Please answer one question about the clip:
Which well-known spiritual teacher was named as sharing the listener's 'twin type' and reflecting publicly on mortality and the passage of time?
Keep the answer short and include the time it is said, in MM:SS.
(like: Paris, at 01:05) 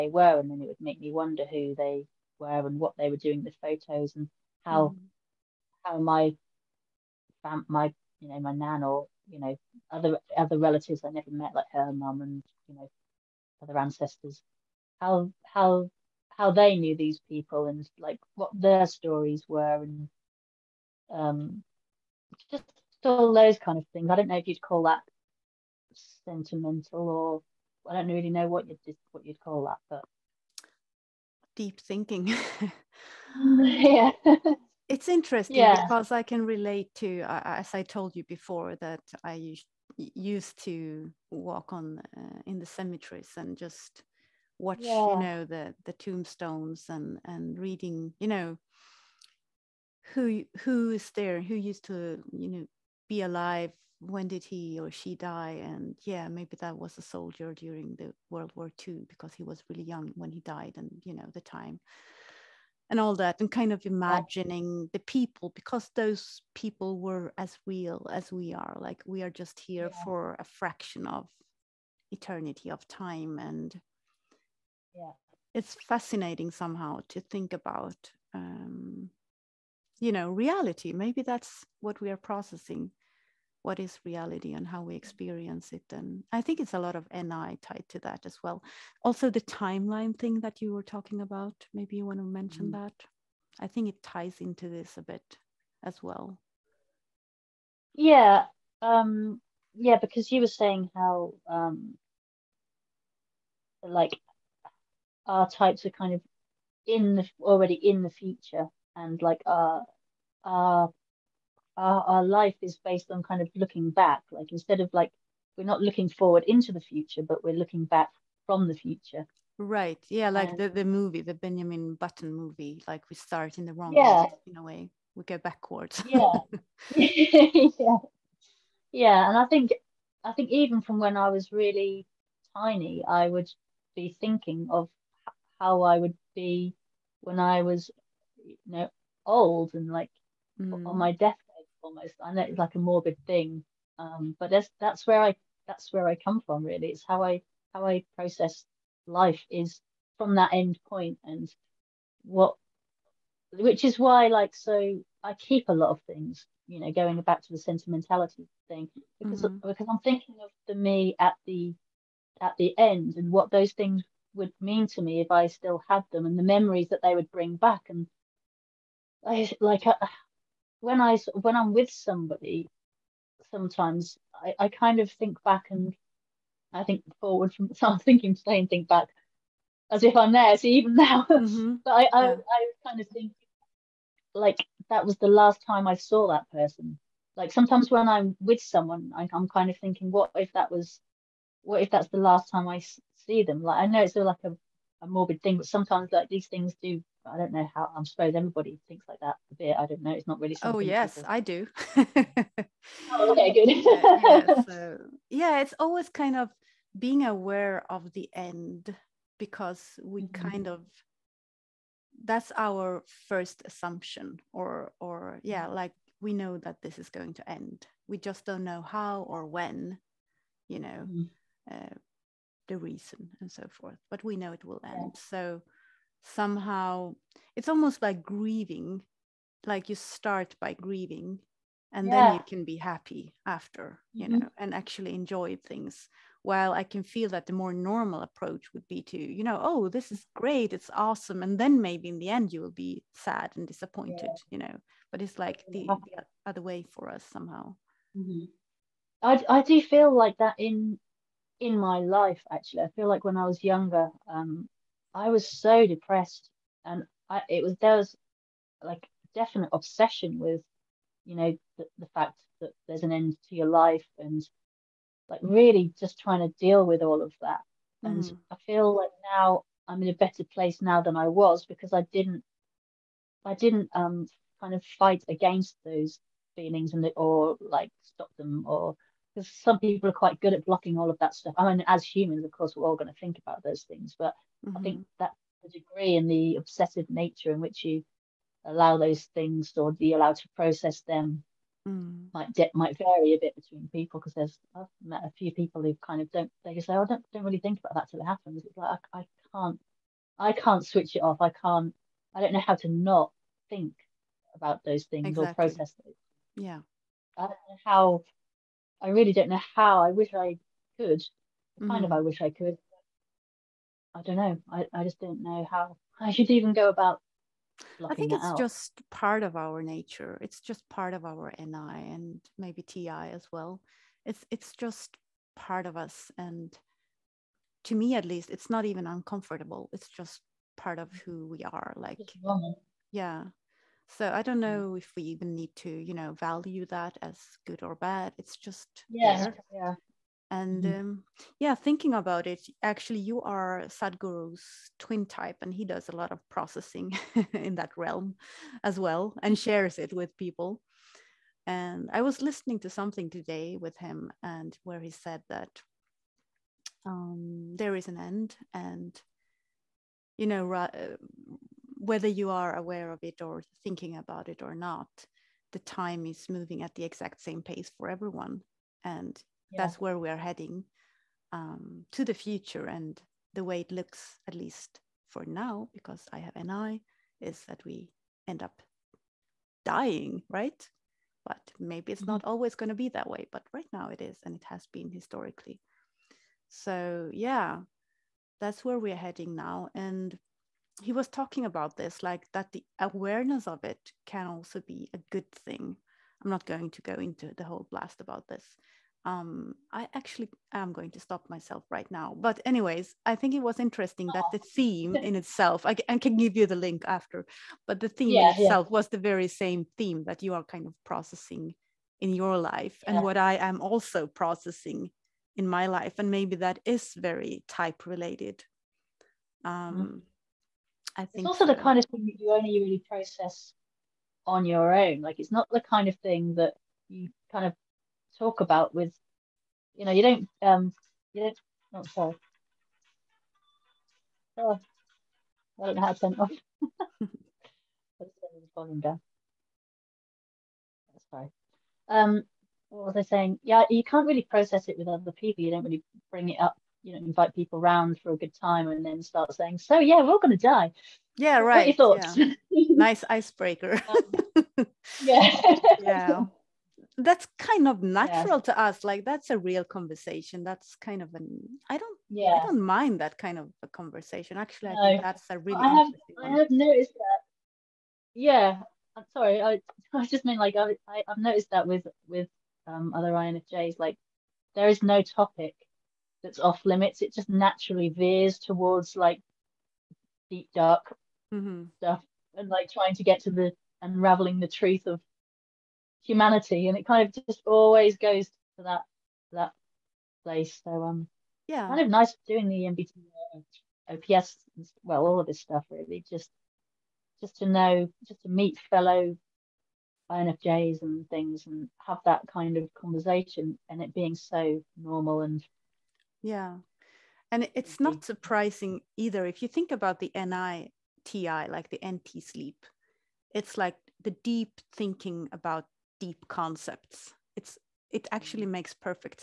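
Sadhguru, at 05:43.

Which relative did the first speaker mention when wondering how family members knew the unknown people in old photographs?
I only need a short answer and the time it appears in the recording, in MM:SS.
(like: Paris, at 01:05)
nan, at 00:08.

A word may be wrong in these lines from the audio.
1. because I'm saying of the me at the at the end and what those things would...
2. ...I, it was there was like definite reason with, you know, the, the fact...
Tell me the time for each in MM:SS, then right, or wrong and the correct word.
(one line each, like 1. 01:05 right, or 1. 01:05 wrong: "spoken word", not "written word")
1. 02:39 wrong: "thinking", not "saying"
2. 04:17 wrong: "obsession", not "reason".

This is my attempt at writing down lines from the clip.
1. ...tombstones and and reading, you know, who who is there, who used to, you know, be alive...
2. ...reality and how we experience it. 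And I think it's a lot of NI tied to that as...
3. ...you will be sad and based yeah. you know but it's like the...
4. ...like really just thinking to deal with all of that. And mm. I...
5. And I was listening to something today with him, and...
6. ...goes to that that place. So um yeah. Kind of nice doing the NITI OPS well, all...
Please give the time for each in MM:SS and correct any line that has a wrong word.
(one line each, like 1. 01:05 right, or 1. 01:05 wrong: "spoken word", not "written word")
1. 00:45 right
2. 01:24 right
3. 04:02 wrong: "disappointed", not "based"
4. 04:25 wrong: "trying", not "thinking"
5. 05:51 right
6. 08:08 wrong: "MBT", not "NITI".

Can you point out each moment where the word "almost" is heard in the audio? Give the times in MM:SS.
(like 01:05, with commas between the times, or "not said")
02:21, 03:47.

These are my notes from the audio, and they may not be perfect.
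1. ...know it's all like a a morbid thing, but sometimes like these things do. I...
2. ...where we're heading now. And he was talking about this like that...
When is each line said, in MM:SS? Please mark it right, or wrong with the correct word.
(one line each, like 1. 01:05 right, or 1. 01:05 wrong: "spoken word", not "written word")
1. 03:13 right
2. 06:28 right.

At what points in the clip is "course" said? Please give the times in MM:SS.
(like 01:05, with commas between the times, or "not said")
04:42.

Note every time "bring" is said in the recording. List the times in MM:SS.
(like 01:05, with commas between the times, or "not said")
02:47, 07:26.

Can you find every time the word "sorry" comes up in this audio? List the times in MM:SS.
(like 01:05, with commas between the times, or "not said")
07:12, 07:49.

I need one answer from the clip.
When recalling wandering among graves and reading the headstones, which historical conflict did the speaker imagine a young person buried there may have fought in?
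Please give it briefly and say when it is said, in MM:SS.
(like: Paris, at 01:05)
World War II, at 00:58.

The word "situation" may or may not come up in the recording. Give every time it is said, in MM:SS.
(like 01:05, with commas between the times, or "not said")
not said.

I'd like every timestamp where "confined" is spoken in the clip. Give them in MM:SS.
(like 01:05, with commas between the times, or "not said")
not said.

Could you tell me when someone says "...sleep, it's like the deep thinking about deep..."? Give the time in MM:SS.
08:32.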